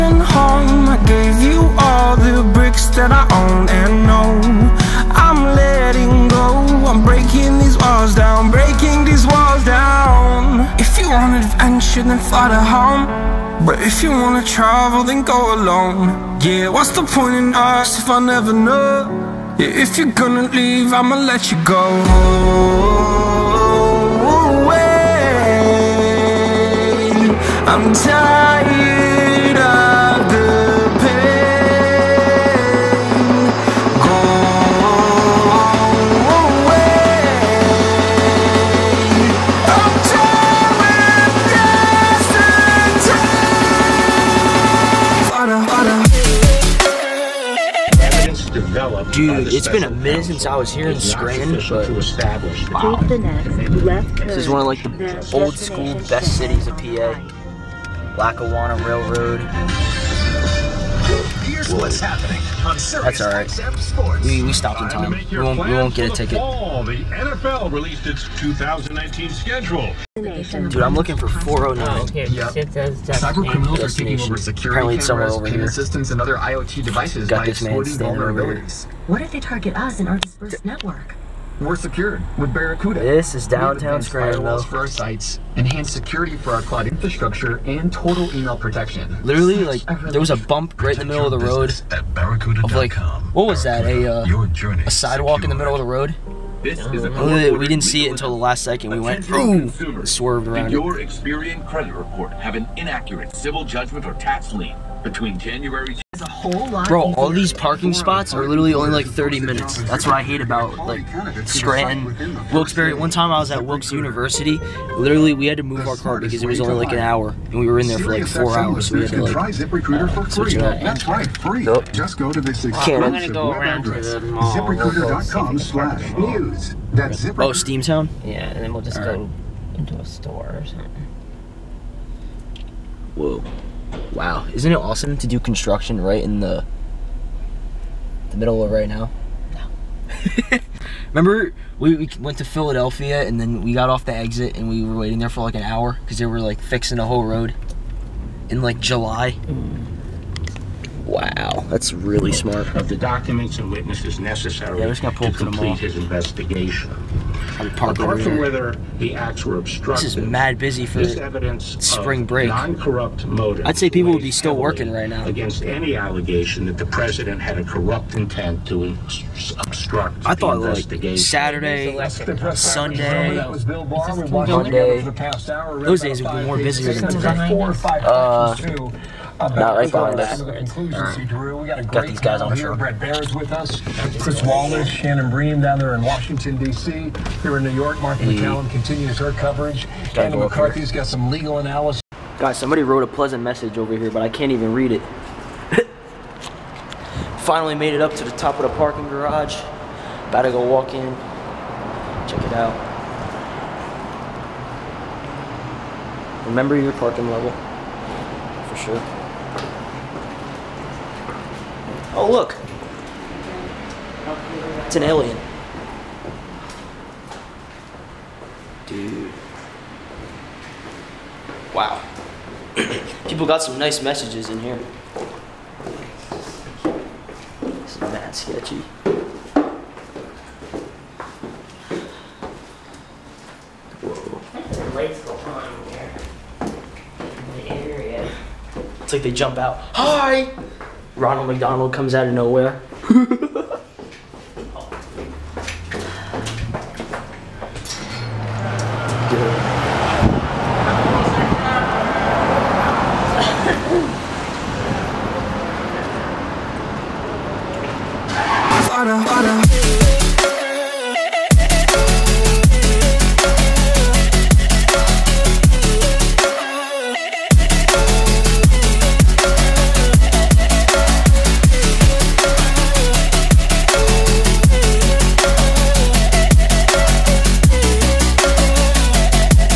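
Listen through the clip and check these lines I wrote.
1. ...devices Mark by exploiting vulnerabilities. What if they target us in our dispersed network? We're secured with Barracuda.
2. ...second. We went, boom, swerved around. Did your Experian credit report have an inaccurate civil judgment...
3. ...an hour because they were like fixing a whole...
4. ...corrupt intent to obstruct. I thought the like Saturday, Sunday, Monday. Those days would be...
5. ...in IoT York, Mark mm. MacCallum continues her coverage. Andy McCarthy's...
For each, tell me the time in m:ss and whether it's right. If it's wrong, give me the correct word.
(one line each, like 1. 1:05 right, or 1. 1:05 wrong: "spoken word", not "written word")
1. 1:16 wrong: "Got", not "Mark"
2. 1:38 right
3. 2:25 right
4. 2:47 right
5. 3:07 wrong: "New", not "IoT".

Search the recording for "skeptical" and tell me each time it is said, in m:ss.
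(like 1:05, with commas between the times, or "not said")
not said.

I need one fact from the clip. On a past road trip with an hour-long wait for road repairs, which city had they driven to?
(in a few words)
Philadelphia.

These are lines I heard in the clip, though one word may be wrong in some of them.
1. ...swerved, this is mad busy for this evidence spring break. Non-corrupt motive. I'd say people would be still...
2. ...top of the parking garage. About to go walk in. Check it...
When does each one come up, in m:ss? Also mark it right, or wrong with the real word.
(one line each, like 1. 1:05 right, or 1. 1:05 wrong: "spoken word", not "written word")
1. 2:39 wrong: "obstructed", not "swerved"
2. 3:18 right.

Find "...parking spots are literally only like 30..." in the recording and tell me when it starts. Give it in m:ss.
1:47.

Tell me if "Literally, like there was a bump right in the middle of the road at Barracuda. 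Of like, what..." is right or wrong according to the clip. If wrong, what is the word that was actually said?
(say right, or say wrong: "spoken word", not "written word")
right.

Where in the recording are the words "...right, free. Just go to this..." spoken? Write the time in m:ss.
2:01.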